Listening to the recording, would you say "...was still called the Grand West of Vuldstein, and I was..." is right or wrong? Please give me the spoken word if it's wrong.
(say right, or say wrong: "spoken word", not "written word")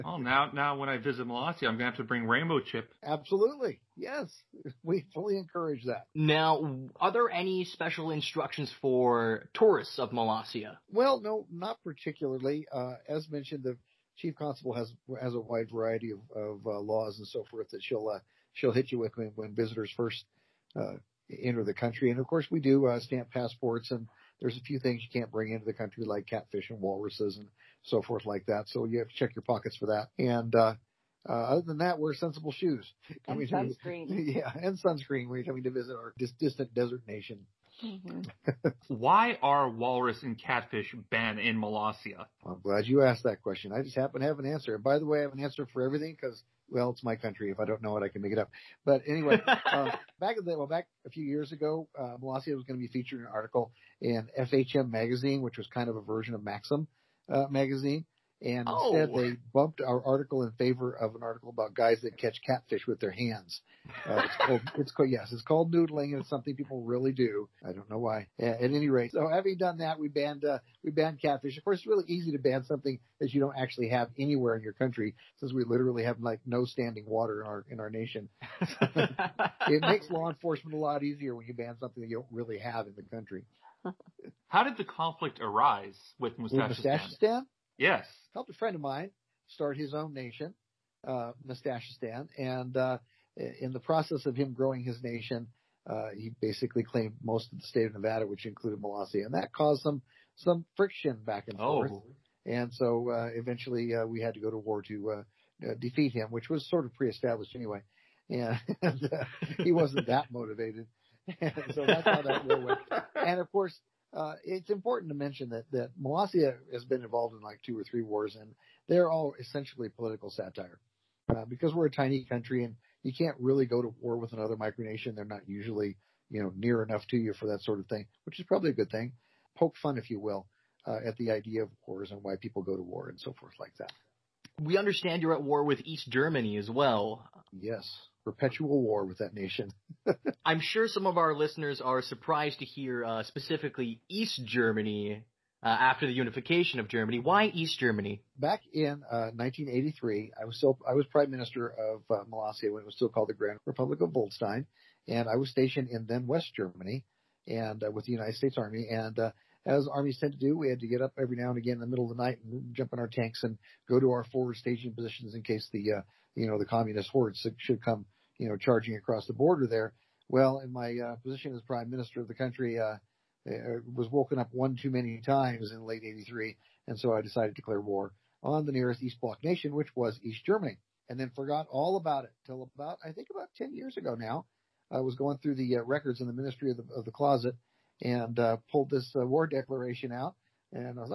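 wrong: "Republic", not "West".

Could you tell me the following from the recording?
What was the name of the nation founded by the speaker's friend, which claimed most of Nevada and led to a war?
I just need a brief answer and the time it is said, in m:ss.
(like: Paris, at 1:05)
Mustachistan, at 1:31.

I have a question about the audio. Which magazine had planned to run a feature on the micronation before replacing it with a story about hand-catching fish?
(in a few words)
FHM.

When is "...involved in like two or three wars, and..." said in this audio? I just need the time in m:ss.
1:57.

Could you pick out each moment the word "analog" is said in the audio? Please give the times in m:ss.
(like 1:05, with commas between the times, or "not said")
not said.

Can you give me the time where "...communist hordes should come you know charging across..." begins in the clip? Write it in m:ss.
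2:46.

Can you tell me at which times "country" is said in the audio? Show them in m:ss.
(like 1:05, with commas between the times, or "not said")
0:21, 0:25, 0:47, 1:14, 1:23, 2:02, 2:52.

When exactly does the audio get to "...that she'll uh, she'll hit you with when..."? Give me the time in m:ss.
0:17.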